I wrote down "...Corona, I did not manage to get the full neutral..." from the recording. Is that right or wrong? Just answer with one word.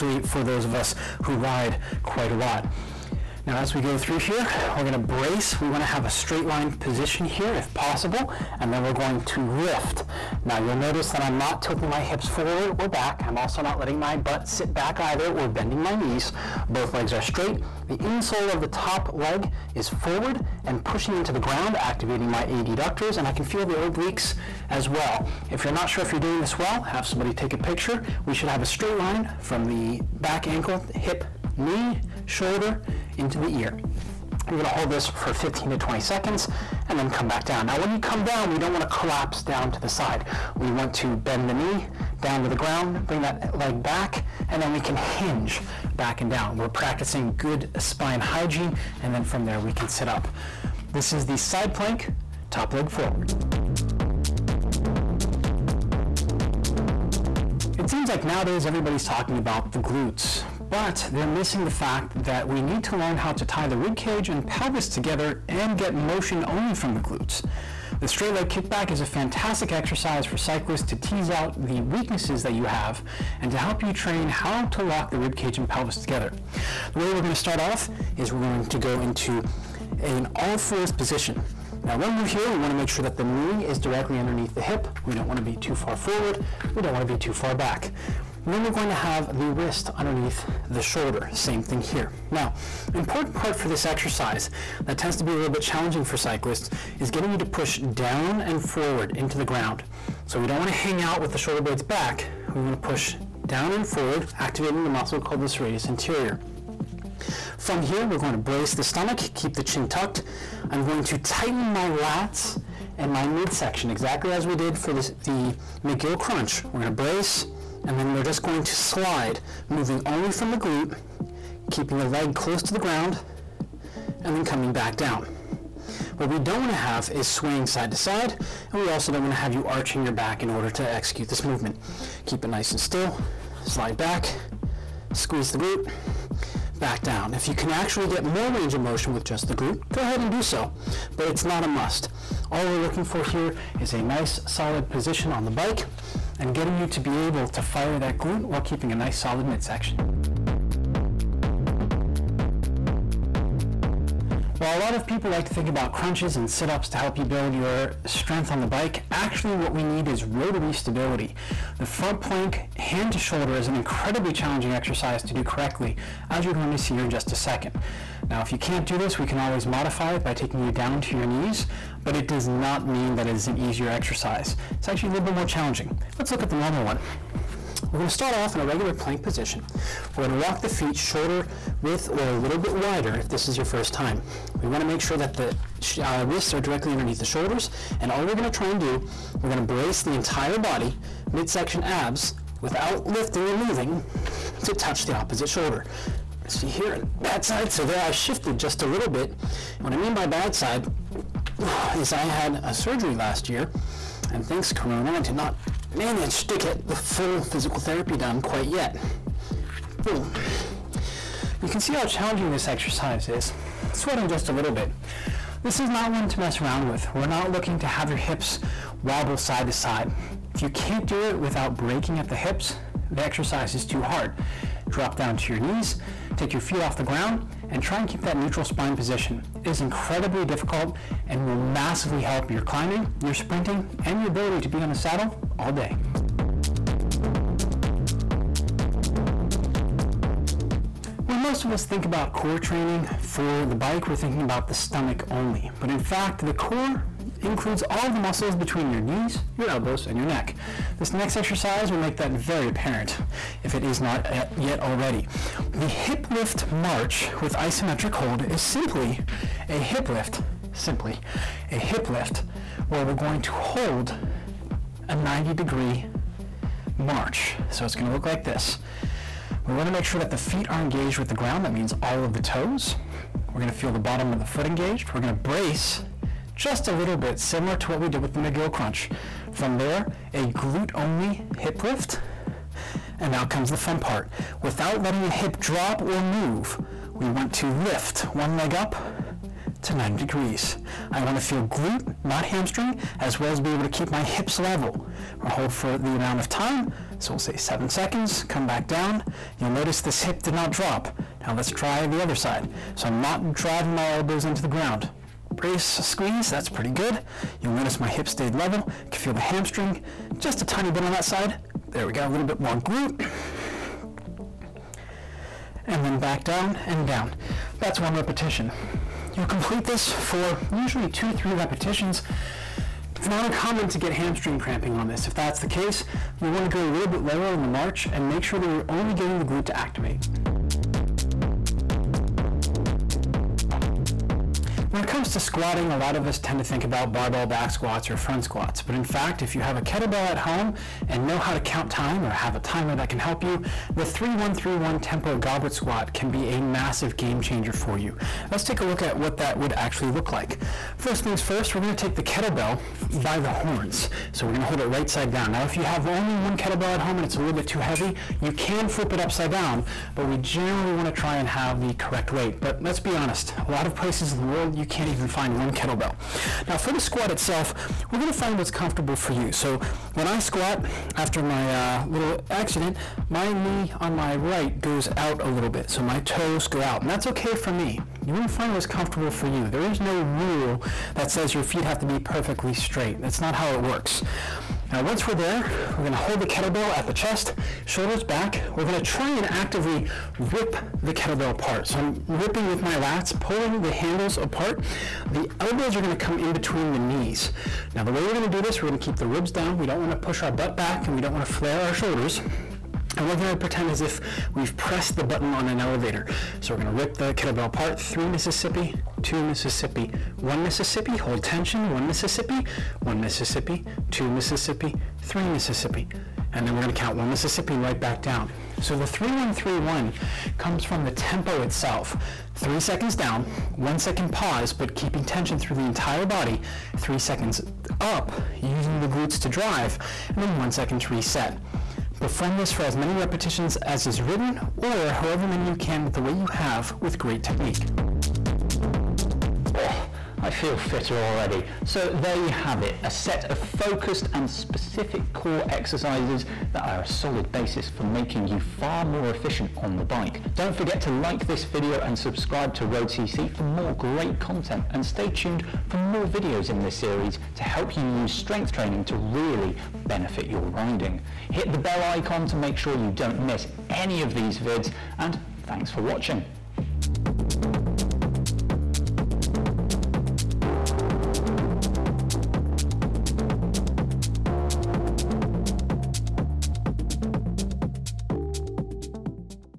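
wrong.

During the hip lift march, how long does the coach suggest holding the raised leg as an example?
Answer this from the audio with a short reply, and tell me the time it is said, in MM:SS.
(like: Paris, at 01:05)
7 seconds, at 04:57.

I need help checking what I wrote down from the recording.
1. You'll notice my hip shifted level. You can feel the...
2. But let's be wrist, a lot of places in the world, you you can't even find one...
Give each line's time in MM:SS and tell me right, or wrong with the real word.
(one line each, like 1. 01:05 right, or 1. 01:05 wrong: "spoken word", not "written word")
1. 05:07 wrong: "stayed", not "shifted"
2. 06:02 wrong: "honest", not "wrist".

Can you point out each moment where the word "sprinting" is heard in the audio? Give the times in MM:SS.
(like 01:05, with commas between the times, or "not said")
03:53.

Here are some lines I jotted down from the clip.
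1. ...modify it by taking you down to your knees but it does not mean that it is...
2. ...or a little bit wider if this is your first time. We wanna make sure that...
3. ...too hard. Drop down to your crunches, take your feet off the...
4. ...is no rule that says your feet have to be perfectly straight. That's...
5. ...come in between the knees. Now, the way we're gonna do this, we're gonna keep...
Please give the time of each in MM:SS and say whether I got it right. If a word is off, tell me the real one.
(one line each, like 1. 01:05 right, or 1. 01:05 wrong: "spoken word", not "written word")
1. 02:49 right
2. 03:02 right
3. 03:43 wrong: "knees", not "crunches"
4. 06:19 right
5. 06:36 right.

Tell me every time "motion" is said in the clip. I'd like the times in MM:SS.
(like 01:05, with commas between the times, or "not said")
01:05, 02:18.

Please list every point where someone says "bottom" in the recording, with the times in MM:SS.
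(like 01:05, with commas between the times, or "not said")
04:33.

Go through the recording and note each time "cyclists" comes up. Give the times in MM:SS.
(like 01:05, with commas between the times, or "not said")
01:10, 01:36.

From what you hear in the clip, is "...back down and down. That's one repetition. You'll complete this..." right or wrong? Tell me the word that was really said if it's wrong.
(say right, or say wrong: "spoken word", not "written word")
right.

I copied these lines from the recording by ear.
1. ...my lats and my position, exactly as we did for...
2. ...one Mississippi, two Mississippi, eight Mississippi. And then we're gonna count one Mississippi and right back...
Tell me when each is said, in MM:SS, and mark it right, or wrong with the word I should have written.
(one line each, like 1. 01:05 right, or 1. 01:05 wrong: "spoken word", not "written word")
1. 01:51 wrong: "midsection", not "position"
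2. 06:53 wrong: "three", not "eight".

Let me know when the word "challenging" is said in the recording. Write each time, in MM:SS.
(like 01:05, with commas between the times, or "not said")
01:35, 02:44, 02:55, 03:32.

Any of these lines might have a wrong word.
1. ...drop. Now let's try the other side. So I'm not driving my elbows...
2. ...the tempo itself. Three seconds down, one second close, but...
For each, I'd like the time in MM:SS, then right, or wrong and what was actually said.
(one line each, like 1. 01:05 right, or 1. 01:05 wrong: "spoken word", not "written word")
1. 05:00 right
2. 07:01 wrong: "pause", not "close".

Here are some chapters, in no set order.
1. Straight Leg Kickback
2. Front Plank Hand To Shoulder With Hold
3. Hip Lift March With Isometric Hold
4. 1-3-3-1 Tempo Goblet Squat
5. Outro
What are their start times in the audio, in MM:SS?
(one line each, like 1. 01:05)
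1. 00:53
2. 02:30
3. 03:58
4. 05:31
5. 07:19.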